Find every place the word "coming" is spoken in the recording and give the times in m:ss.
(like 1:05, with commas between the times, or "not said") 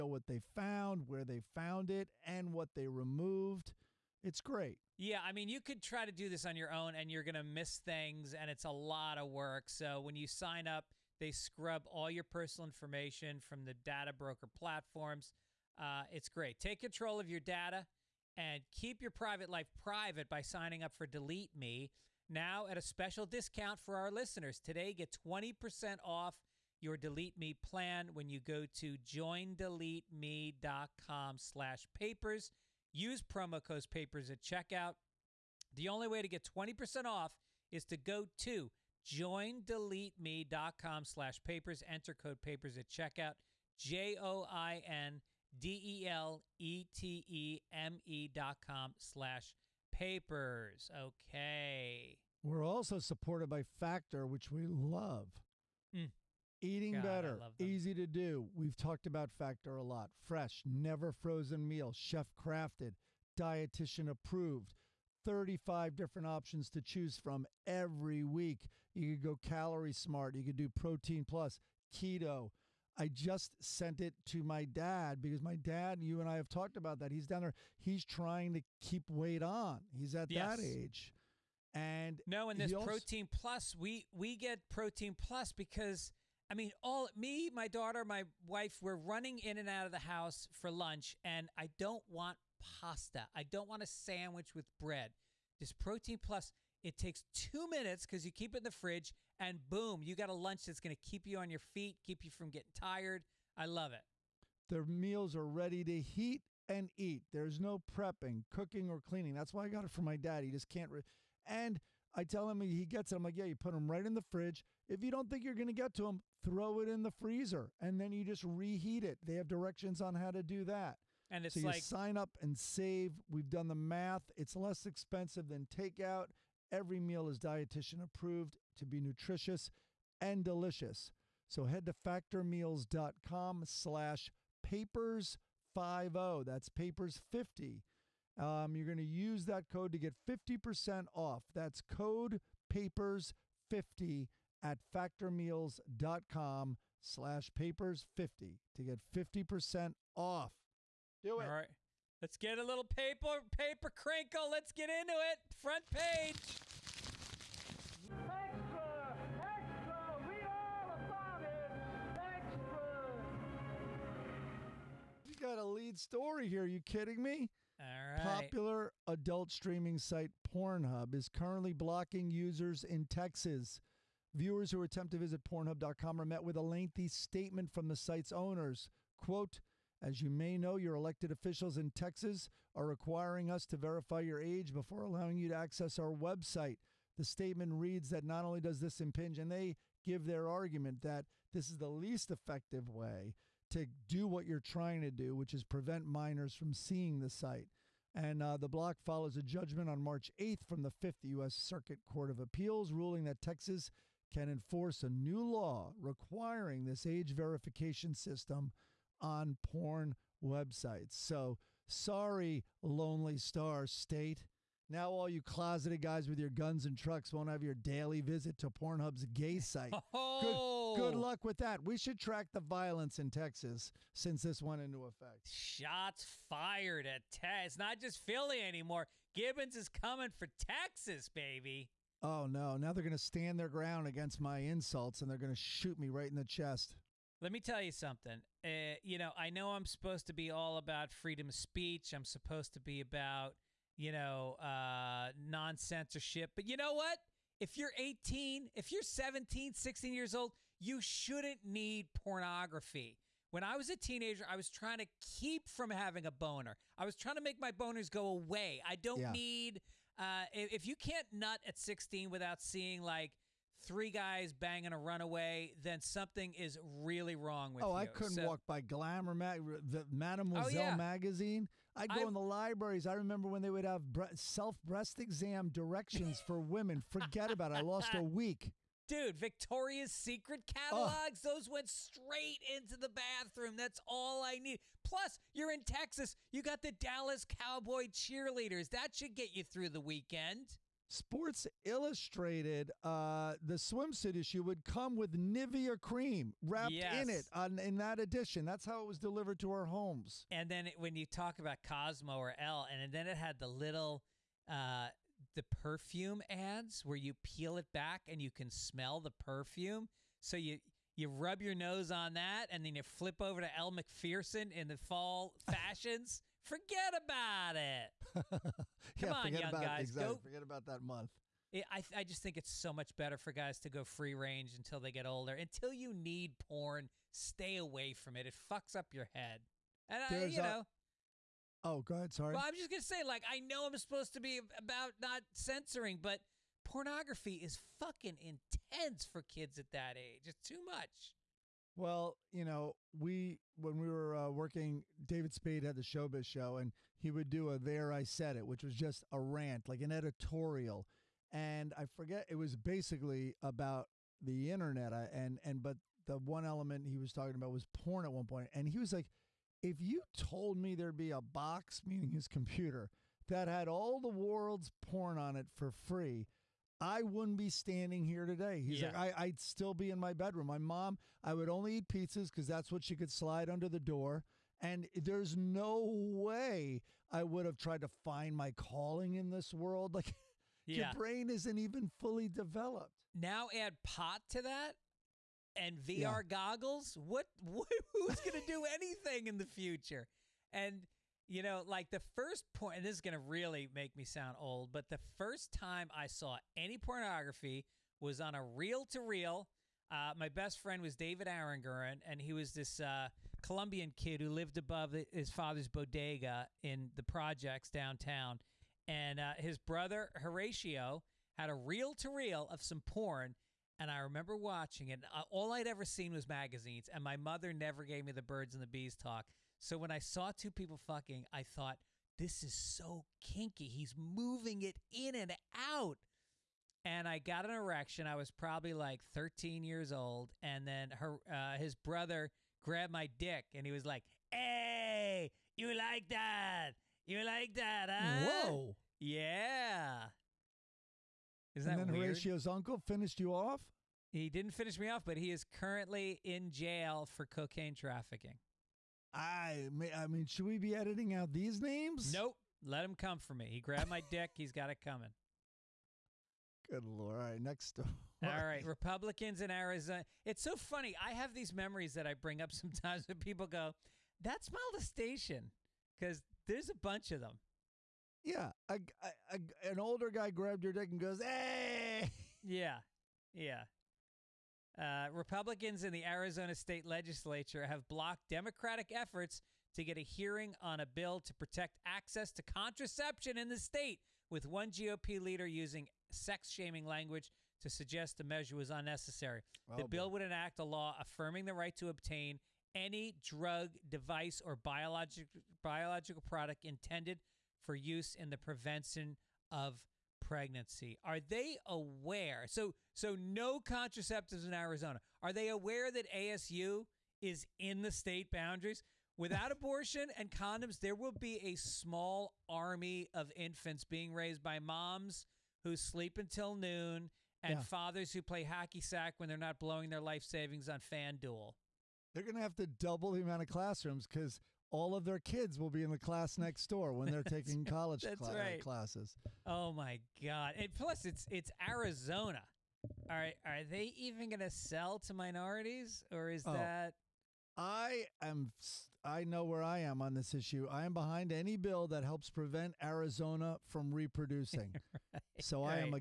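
3:49, 7:35.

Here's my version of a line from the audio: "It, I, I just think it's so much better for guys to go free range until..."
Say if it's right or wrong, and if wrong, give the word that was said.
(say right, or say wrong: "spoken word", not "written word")
right.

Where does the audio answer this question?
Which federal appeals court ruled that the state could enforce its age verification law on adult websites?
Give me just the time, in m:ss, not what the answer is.
3:20.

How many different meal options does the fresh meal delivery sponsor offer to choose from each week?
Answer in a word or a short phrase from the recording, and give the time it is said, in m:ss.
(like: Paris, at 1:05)
35, at 1:05.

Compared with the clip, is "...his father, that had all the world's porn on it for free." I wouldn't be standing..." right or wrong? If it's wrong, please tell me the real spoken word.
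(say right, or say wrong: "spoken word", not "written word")
wrong: "computer", not "father".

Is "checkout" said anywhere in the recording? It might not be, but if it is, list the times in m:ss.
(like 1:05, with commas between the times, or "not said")
0:34, 0:42.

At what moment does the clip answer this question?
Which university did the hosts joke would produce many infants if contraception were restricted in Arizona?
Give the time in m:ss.
8:26.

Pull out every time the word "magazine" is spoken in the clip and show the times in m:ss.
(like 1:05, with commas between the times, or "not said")
4:30, 6:56.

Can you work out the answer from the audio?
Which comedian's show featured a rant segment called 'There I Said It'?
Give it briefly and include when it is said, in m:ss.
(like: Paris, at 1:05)
David Spade, at 5:45.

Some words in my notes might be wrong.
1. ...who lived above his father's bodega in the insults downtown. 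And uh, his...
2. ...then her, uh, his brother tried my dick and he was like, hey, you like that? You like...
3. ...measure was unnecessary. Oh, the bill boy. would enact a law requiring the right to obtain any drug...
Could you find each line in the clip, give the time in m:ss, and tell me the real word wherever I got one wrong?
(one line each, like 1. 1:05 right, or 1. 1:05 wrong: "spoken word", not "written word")
1. 6:44 wrong: "projects", not "insults"
2. 7:10 wrong: "grabbed", not "tried"
3. 8:08 wrong: "affirming", not "requiring".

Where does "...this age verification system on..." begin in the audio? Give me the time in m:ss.
3:26.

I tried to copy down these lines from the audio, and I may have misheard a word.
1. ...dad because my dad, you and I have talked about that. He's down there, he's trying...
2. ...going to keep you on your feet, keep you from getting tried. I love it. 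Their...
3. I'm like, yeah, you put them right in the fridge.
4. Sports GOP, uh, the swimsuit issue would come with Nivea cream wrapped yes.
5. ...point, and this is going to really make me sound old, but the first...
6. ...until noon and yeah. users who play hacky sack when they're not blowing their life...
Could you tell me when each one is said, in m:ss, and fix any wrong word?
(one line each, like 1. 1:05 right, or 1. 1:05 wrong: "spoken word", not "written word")
1. 1:14 right
2. 1:40 wrong: "tired", not "tried"
3. 1:53 right
4. 4:51 wrong: "Illustrated", not "GOP"
5. 6:32 right
6. 8:36 wrong: "fathers", not "users".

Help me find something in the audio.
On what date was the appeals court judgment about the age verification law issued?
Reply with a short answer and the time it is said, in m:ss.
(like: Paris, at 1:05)
March 8th, at 3:20.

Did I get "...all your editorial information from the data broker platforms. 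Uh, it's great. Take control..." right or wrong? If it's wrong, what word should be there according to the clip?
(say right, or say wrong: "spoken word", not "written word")
wrong: "personal", not "editorial".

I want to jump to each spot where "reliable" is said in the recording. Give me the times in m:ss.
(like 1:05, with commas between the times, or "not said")
not said.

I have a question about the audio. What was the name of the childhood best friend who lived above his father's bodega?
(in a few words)
David Aranguren.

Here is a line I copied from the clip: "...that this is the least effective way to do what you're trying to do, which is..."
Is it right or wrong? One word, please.
right.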